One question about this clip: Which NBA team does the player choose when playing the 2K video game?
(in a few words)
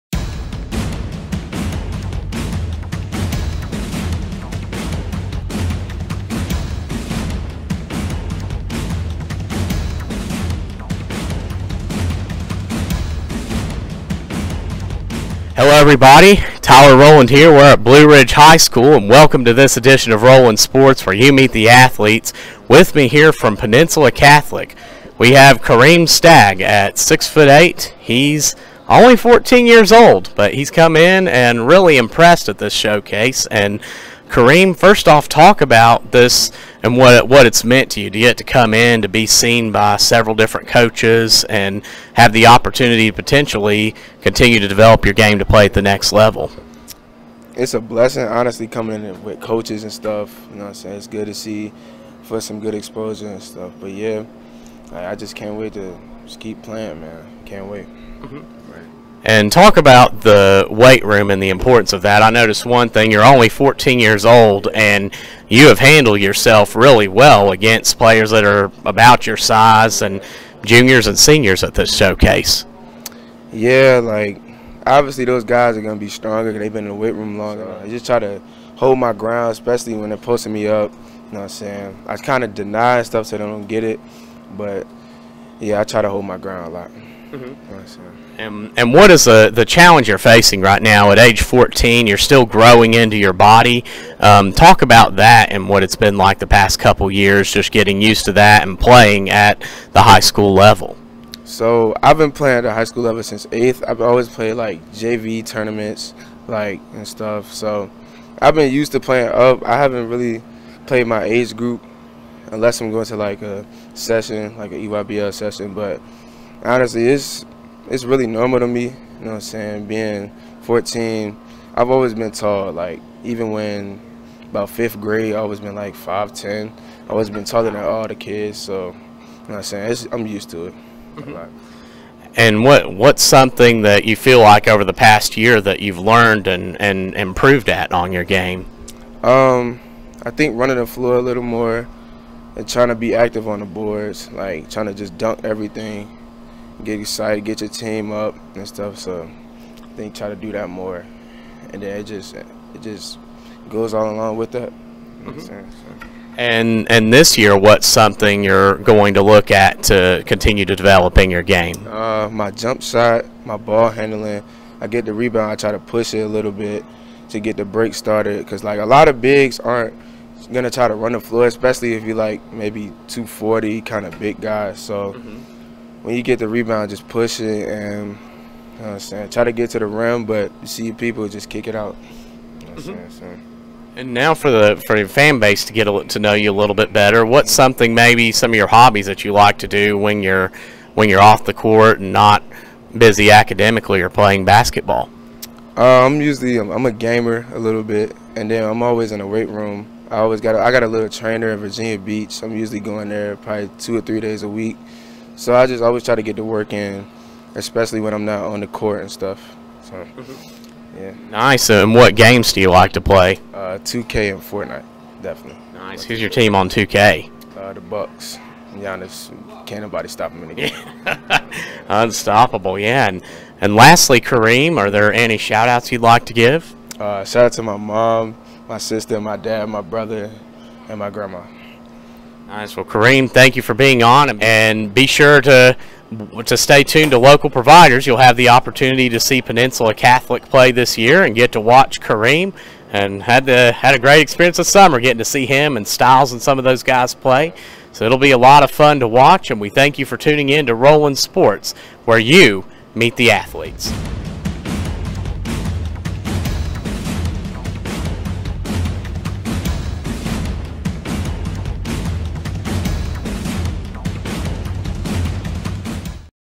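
Bucks.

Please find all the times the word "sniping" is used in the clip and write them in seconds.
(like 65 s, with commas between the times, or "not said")
not said.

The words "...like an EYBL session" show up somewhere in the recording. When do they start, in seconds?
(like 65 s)
114 s.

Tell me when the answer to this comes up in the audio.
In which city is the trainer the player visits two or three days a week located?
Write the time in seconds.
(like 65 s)
201 s.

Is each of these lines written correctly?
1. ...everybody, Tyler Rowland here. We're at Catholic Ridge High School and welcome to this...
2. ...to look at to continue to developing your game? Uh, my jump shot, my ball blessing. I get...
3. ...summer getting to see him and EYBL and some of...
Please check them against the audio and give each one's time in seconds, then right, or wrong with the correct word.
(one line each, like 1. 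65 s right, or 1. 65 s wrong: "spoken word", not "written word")
1. 15 s wrong: "Blue", not "Catholic"
2. 159 s wrong: "handling", not "blessing"
3. 244 s wrong: "Styles", not "EYBL".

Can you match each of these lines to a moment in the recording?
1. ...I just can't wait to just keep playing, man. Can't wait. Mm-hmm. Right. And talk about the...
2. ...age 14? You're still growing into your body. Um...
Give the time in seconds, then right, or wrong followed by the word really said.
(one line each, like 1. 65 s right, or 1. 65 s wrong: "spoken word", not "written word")
1. 54 s right
2. 91 s right.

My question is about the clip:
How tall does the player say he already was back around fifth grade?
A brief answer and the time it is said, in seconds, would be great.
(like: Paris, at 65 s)
5'10", at 125 s.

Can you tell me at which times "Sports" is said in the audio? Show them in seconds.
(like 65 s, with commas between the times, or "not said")
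20 s, 251 s.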